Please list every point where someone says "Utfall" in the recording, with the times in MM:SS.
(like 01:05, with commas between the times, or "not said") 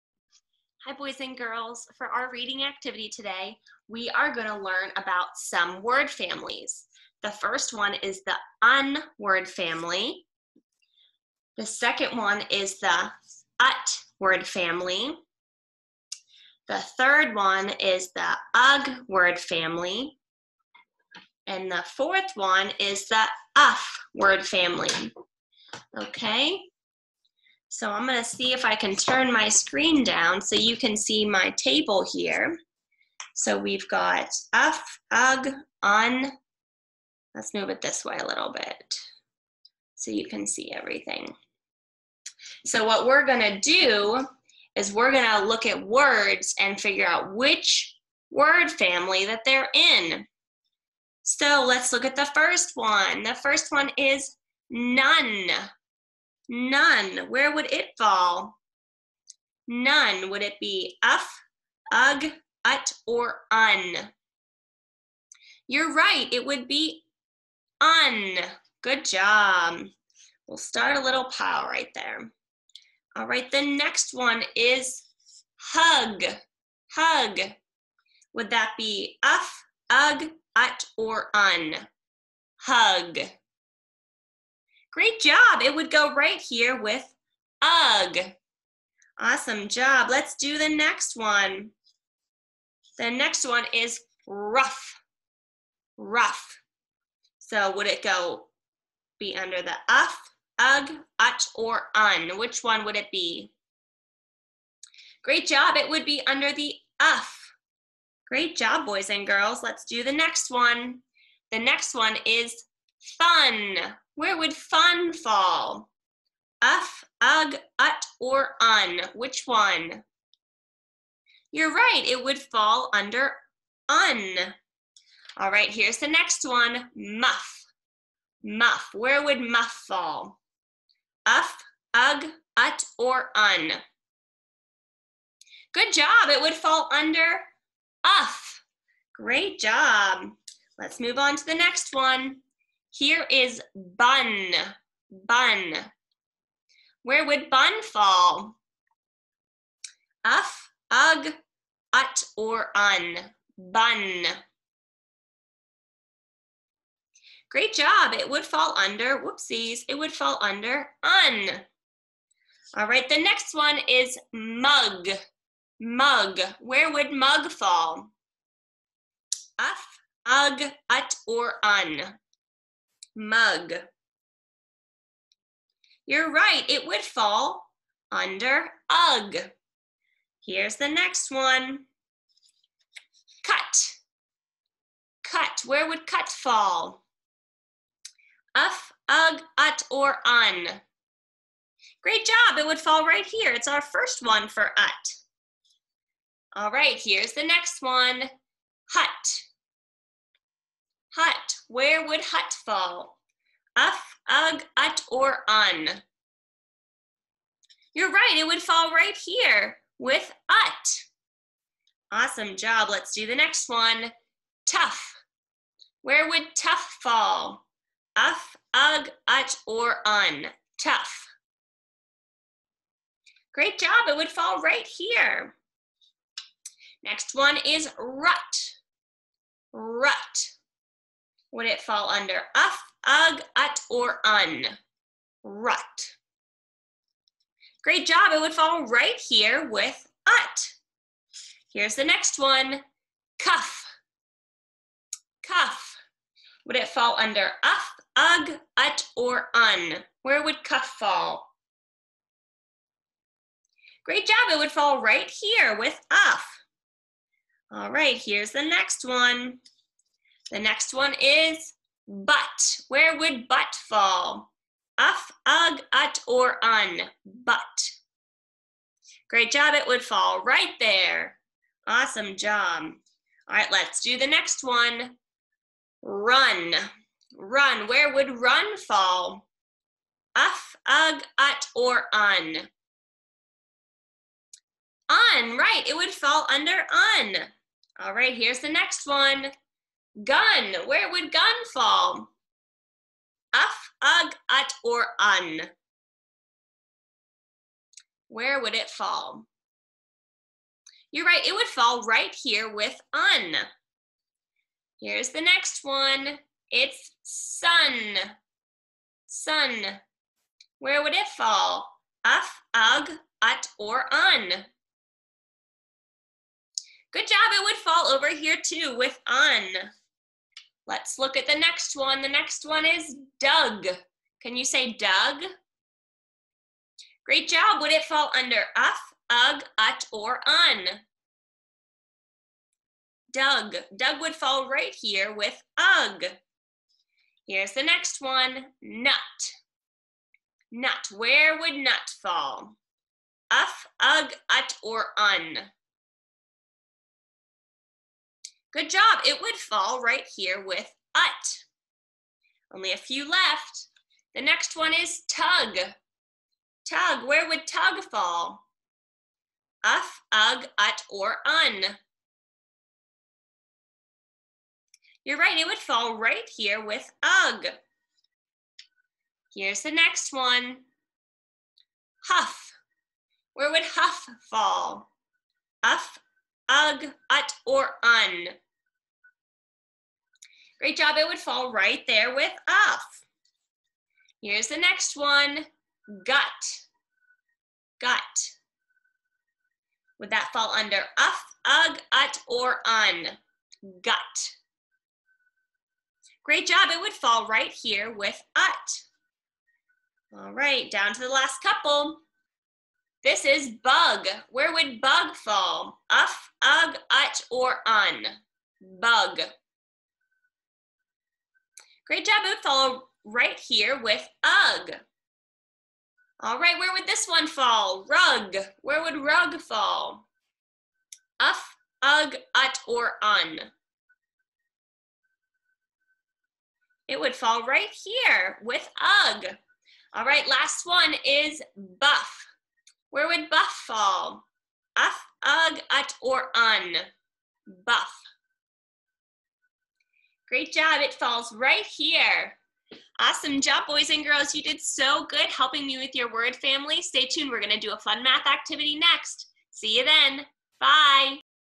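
06:52.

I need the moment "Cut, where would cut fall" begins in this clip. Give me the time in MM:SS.
03:05.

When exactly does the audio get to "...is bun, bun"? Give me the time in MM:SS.
02:23.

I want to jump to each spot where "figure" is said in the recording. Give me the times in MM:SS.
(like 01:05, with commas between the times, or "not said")
00:46.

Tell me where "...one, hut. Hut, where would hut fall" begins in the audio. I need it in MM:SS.
03:17.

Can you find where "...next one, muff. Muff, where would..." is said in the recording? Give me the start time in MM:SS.
02:06.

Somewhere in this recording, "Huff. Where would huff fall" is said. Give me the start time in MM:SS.
06:12.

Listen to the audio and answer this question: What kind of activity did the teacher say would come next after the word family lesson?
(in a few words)
math activity.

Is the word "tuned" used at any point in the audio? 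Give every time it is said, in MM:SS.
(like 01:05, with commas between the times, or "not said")
07:27.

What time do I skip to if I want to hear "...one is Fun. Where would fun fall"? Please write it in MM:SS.
01:51.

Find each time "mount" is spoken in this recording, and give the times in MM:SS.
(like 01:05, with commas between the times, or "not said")
not said.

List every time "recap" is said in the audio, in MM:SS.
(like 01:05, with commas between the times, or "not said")
not said.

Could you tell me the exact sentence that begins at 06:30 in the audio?
Would that fall under uff, ug, ut, or un?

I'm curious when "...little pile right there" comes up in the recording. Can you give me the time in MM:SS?
01:11.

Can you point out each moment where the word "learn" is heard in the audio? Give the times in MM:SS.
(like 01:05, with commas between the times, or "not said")
00:04.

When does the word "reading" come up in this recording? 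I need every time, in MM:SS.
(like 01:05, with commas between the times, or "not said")
00:02.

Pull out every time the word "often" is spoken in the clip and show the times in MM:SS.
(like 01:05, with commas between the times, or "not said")
not said.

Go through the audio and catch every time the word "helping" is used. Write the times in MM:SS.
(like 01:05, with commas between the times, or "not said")
07:25.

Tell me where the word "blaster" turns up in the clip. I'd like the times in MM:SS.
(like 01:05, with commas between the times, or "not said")
not said.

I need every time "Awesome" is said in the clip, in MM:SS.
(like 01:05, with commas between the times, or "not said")
01:29, 03:32, 04:31, 07:23.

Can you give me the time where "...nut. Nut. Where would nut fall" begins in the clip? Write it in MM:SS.
05:38.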